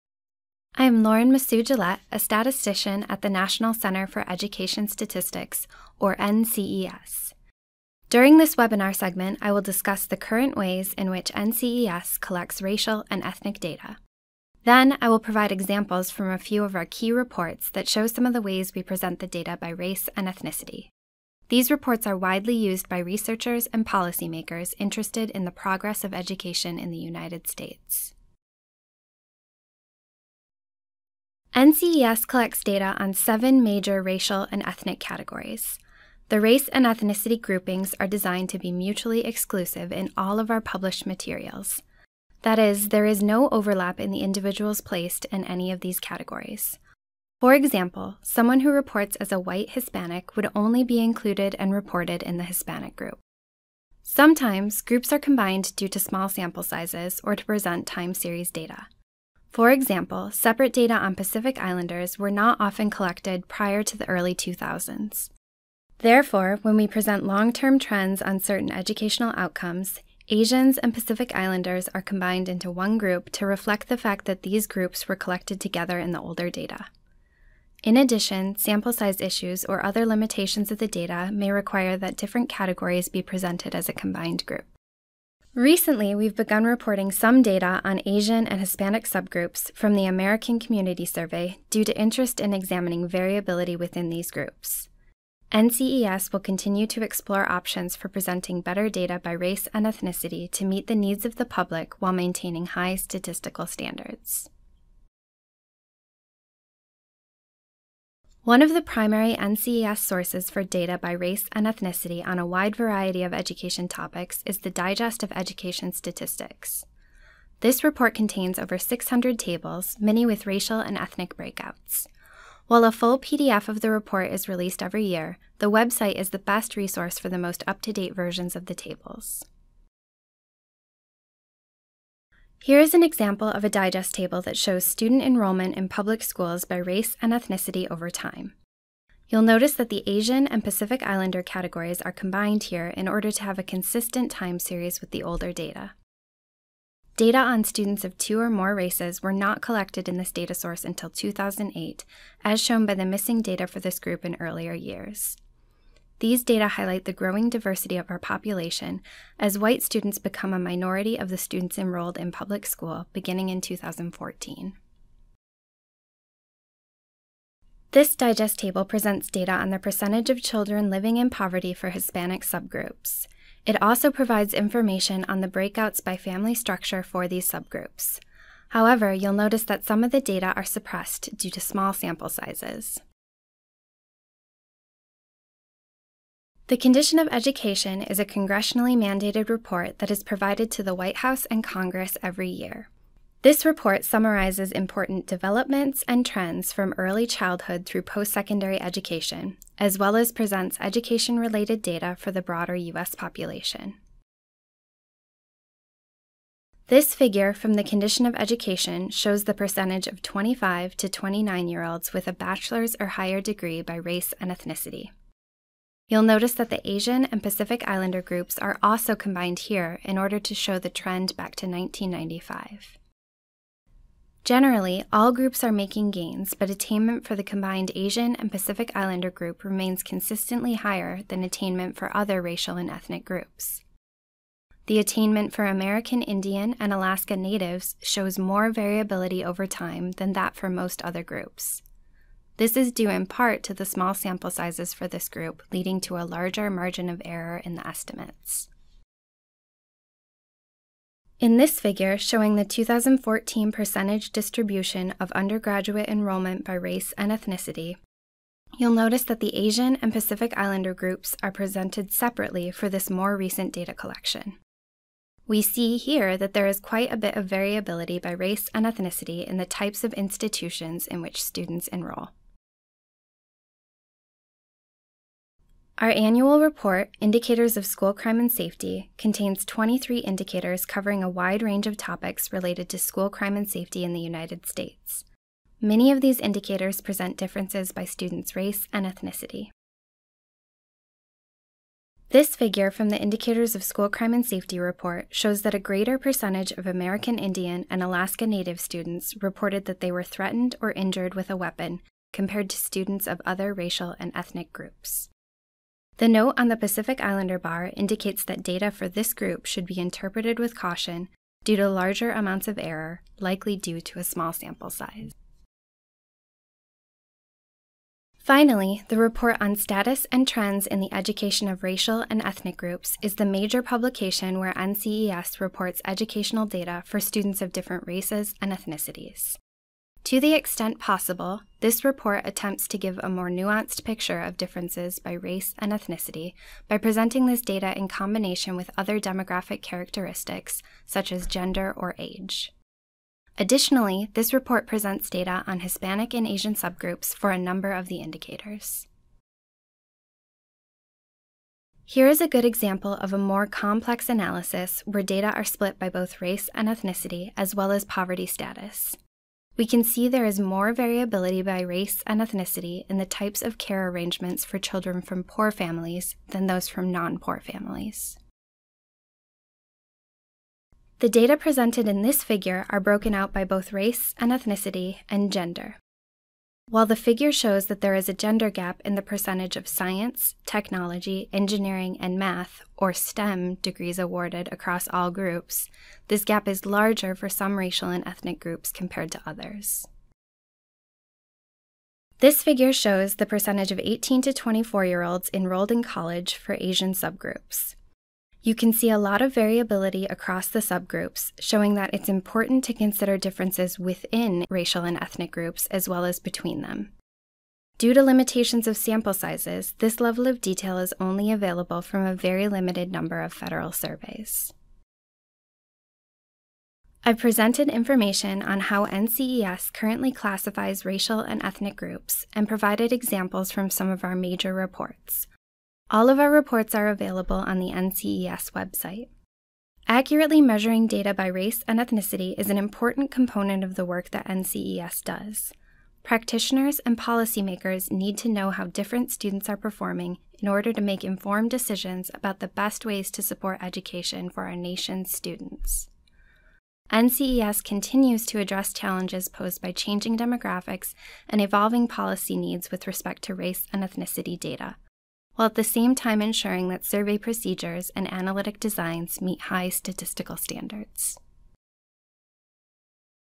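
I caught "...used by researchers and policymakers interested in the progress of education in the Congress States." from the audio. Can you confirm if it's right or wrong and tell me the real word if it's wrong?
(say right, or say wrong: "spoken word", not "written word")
wrong: "United", not "Congress".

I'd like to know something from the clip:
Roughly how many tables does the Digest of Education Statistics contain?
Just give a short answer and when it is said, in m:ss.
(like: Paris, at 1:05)
Over 600, at 1:58.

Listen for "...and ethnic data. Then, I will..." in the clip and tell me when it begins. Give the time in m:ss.
0:13.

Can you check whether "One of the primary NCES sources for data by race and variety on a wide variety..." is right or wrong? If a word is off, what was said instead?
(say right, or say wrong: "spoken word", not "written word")
wrong: "ethnicity", not "variety".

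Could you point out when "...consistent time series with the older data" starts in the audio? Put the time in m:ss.
2:23.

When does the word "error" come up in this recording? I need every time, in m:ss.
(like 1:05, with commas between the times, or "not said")
4:07, 5:12.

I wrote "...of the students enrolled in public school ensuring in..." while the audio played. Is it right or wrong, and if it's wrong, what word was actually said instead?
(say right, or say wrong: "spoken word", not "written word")
wrong: "beginning", not "ensuring".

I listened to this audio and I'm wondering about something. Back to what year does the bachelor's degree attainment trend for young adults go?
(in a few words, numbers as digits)
1995.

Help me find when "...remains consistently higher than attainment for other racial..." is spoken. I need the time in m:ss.
3:49.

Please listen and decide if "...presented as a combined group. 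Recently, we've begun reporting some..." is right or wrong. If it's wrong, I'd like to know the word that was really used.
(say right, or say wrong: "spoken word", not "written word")
right.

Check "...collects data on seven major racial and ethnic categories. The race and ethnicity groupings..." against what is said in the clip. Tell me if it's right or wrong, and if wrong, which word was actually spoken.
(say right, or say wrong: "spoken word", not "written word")
right.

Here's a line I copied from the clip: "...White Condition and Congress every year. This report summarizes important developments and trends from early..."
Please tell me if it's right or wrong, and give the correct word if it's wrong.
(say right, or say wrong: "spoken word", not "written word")
wrong: "House", not "Condition".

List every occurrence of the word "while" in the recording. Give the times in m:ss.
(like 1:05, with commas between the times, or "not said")
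1:41, 2:02, 6:16, 7:35.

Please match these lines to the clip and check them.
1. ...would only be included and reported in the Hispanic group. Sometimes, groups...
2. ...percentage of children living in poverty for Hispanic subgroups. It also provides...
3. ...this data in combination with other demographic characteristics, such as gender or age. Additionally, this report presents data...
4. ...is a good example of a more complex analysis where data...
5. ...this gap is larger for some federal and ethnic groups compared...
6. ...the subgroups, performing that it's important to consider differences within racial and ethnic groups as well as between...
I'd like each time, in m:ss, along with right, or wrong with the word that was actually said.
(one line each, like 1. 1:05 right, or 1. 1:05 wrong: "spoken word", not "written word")
1. 0:50 right
2. 2:49 right
3. 5:37 right
4. 5:52 right
5. 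6:26 wrong: "racial", not "federal"
6. 6:40 wrong: "showing", not "performing".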